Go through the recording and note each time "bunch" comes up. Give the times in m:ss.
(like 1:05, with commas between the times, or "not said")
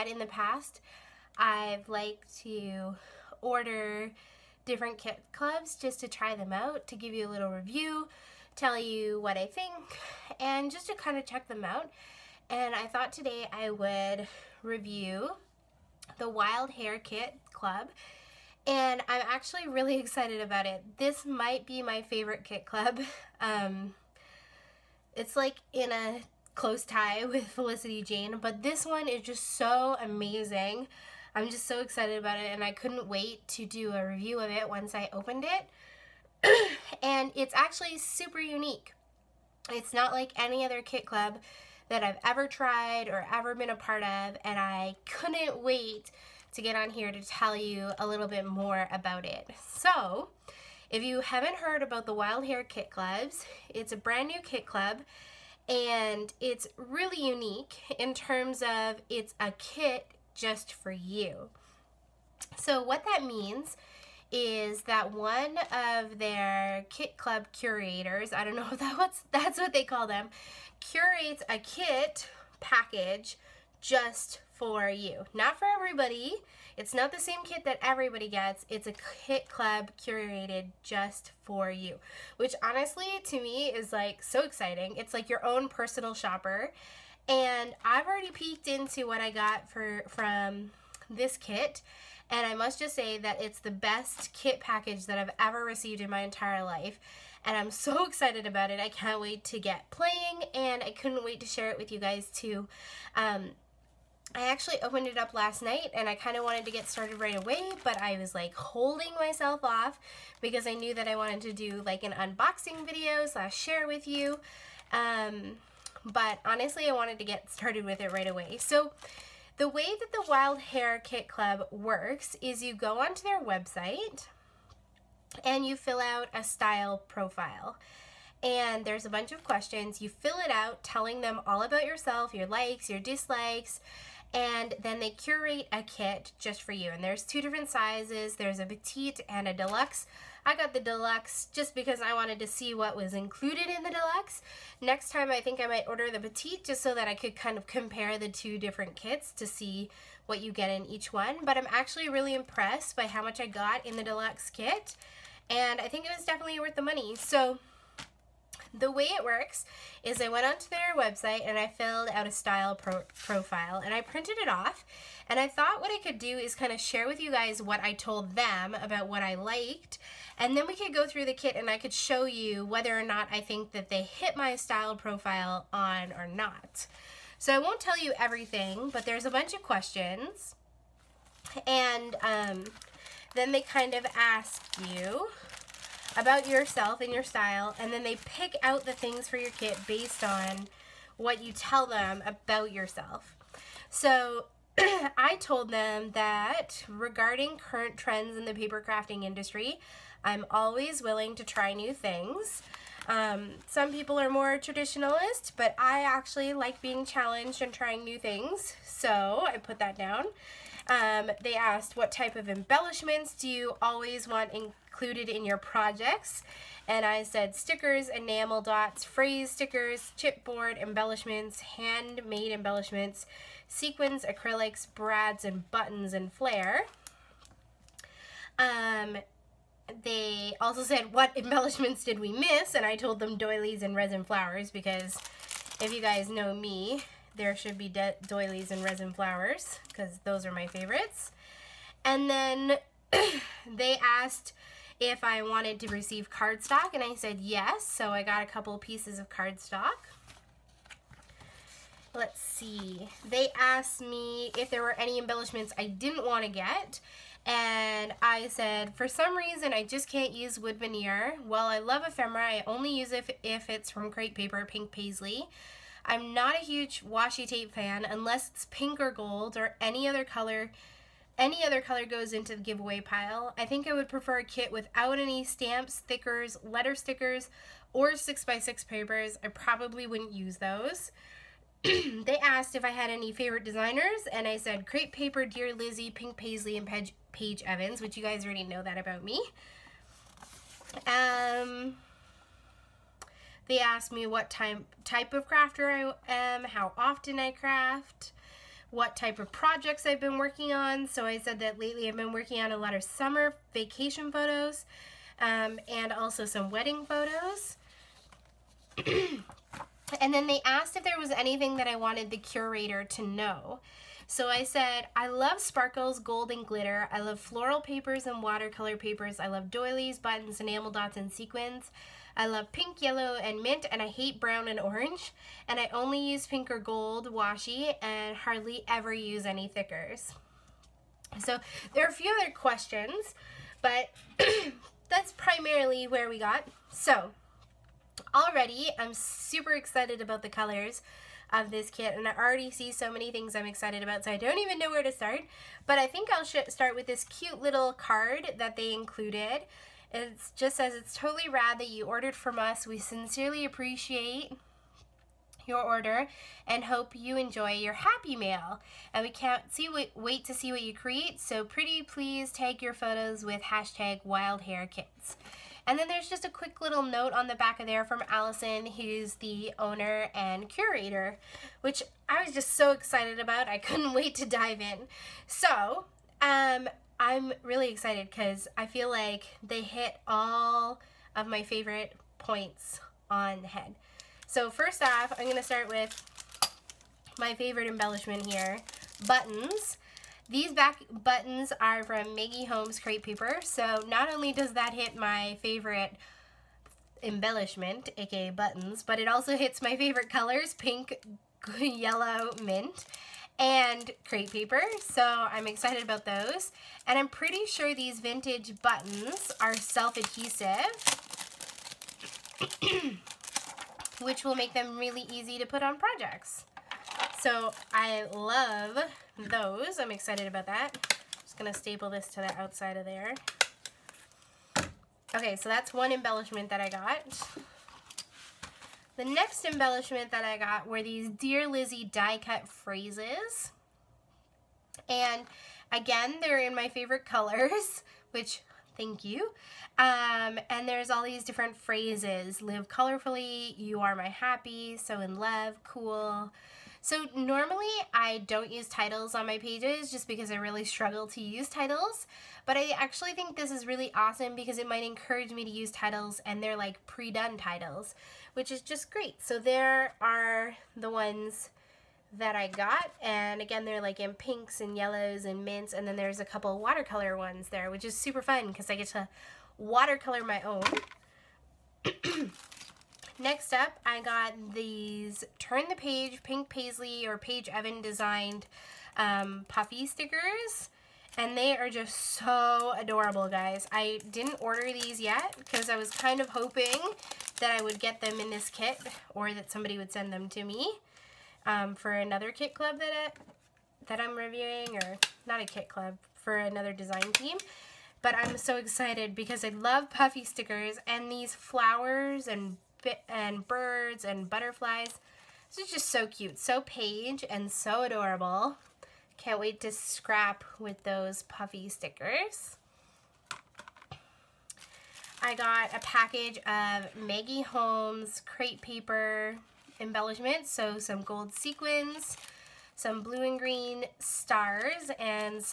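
2:09, 2:59.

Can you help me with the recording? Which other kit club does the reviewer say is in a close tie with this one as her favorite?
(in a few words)
Felicity Jane.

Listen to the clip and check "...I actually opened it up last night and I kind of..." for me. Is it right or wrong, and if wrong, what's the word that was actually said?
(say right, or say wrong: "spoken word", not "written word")
right.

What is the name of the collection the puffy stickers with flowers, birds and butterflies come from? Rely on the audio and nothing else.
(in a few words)
Turn the Page.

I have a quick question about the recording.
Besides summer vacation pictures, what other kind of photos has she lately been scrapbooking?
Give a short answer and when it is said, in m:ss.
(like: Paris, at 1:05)
Wedding photos, at 5:06.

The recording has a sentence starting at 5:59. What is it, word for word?
And we can't see wait, wait to see what you create, so pretty please tag your photos with hashtag wild hare kits.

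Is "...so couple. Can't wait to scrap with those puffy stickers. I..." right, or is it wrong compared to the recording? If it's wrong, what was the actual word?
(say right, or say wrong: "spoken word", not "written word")
wrong: "adorable", not "couple".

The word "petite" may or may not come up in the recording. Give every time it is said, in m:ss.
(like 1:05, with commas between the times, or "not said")
2:18, 2:26.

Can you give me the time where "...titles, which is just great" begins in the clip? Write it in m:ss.
7:37.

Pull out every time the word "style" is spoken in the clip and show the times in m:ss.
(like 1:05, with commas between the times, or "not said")
2:06, 2:42, 2:54, 3:07.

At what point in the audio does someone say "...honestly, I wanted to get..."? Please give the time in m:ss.
1:56.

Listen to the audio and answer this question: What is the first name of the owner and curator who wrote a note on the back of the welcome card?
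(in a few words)
Allison.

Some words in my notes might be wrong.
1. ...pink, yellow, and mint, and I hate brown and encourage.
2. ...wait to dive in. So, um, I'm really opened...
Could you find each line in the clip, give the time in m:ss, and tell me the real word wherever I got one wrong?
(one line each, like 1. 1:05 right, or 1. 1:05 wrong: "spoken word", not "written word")
1. 5:22 wrong: "orange", not "encourage"
2. 6:14 wrong: "excited", not "opened".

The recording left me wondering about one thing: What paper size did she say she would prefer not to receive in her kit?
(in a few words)
6x6.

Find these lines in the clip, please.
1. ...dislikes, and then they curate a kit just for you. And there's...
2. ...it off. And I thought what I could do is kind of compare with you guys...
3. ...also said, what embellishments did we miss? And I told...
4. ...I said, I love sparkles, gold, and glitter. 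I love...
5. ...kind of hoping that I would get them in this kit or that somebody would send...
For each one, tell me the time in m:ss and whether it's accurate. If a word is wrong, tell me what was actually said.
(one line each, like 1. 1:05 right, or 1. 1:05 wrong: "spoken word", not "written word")
1. 2:13 right
2. 2:44 wrong: "share", not "compare"
3. 3:50 right
4. 5:14 right
5. 8:06 right.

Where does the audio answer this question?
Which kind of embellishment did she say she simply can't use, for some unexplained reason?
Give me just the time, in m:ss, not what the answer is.
4:20.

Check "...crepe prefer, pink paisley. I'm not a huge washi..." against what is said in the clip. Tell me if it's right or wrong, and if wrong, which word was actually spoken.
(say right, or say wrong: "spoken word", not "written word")
wrong: "paper", not "prefer".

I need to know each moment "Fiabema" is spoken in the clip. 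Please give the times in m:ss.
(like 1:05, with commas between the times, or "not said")
not said.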